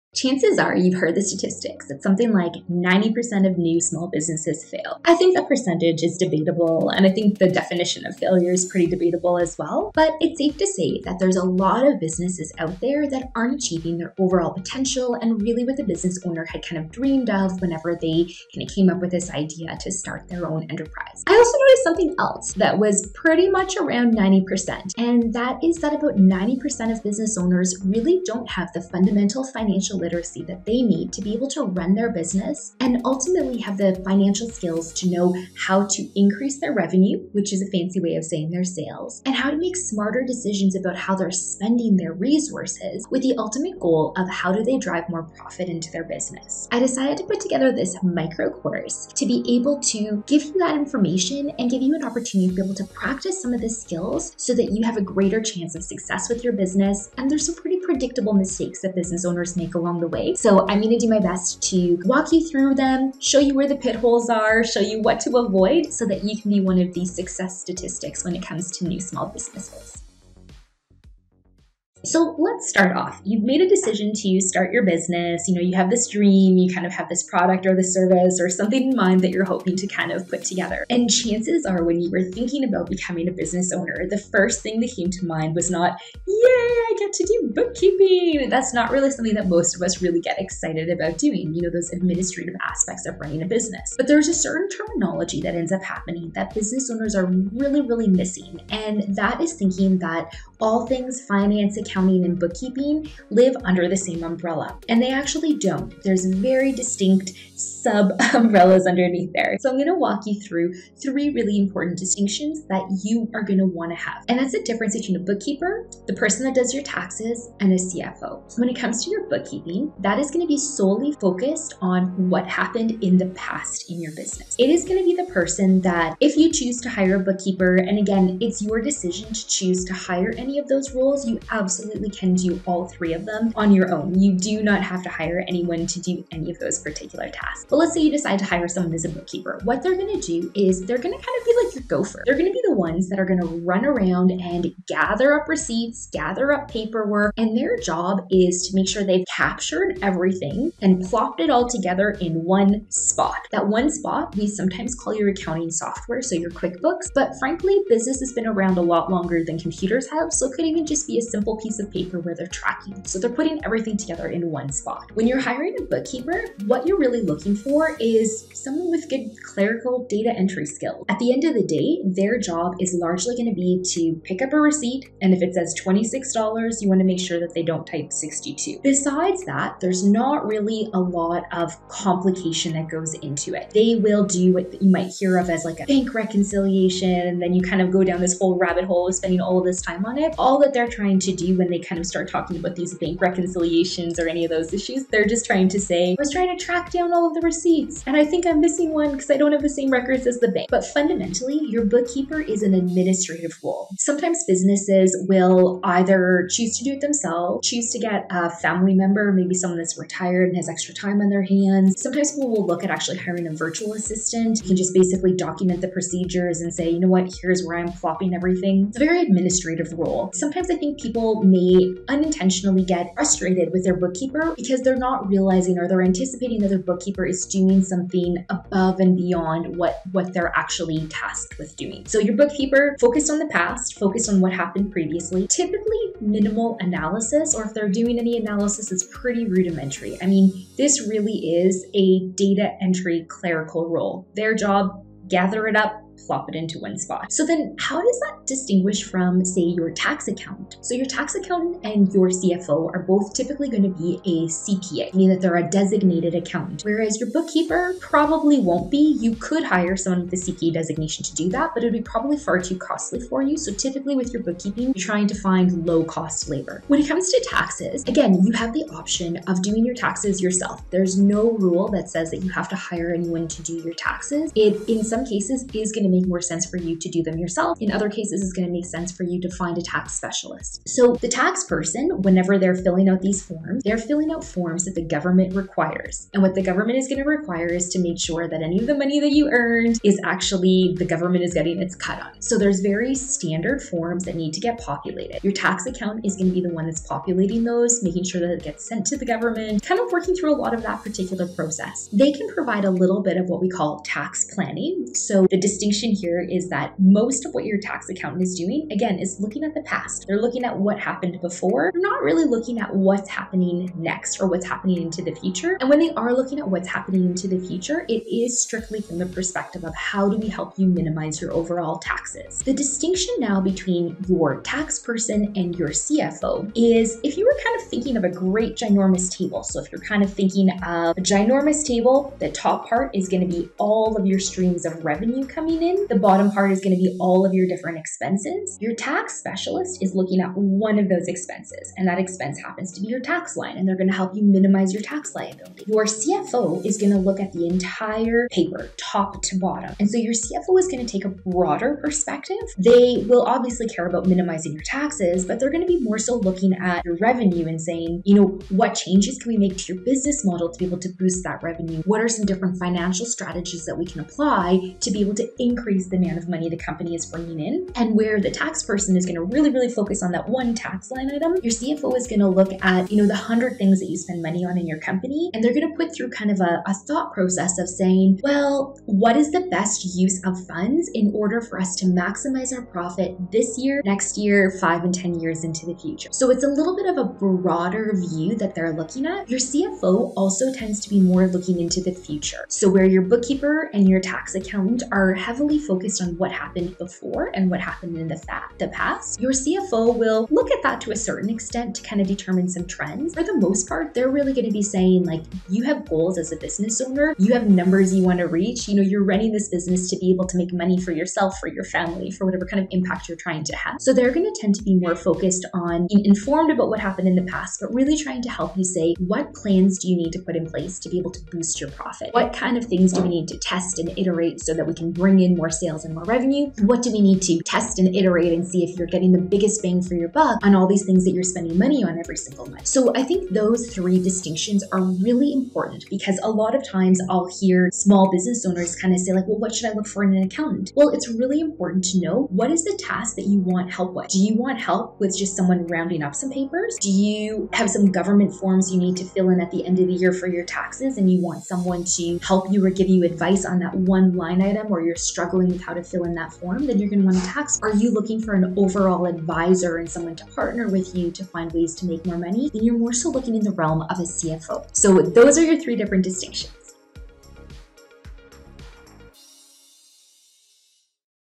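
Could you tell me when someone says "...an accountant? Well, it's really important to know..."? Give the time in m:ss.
7:20.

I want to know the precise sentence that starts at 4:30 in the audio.
There's no rule that says that you have to hire anyone to do your taxes.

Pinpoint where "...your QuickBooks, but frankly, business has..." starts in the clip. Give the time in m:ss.
2:36.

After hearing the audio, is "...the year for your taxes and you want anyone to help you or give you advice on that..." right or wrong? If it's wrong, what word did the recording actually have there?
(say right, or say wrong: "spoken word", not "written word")
wrong: "someone", not "anyone".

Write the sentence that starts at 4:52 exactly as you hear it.
So there's very standard forms that need to get populated.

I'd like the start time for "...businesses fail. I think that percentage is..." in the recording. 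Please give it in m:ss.
0:04.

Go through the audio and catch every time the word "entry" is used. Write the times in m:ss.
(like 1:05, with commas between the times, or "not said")
2:50, 4:02.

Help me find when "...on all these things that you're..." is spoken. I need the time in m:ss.
7:10.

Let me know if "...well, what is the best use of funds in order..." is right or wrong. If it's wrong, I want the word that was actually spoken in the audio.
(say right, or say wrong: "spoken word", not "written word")
right.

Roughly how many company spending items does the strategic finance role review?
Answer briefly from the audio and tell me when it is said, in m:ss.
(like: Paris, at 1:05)
100, at 6:13.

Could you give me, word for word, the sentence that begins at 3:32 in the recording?
Sometimes people will look at actually hiring a virtual assistant.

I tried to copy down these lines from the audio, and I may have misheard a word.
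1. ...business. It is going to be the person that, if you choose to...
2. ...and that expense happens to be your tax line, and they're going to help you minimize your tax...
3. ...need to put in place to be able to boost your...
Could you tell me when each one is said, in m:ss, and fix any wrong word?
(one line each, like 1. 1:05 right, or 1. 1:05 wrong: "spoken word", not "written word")
1. 2:04 right
2. 5:41 right
3. 7:00 right.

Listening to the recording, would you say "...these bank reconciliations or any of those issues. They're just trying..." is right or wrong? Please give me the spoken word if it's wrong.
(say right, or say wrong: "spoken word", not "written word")
right.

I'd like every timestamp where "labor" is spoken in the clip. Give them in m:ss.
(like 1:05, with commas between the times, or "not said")
4:26.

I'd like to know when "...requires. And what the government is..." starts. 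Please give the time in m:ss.
4:45.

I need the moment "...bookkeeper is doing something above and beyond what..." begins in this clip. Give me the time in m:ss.
3:46.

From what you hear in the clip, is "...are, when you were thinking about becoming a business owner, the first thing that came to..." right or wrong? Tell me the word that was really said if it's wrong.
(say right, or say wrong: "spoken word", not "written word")
right.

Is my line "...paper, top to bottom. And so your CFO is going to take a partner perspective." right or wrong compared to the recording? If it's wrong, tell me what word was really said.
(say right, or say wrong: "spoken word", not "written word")
wrong: "broader", not "partner".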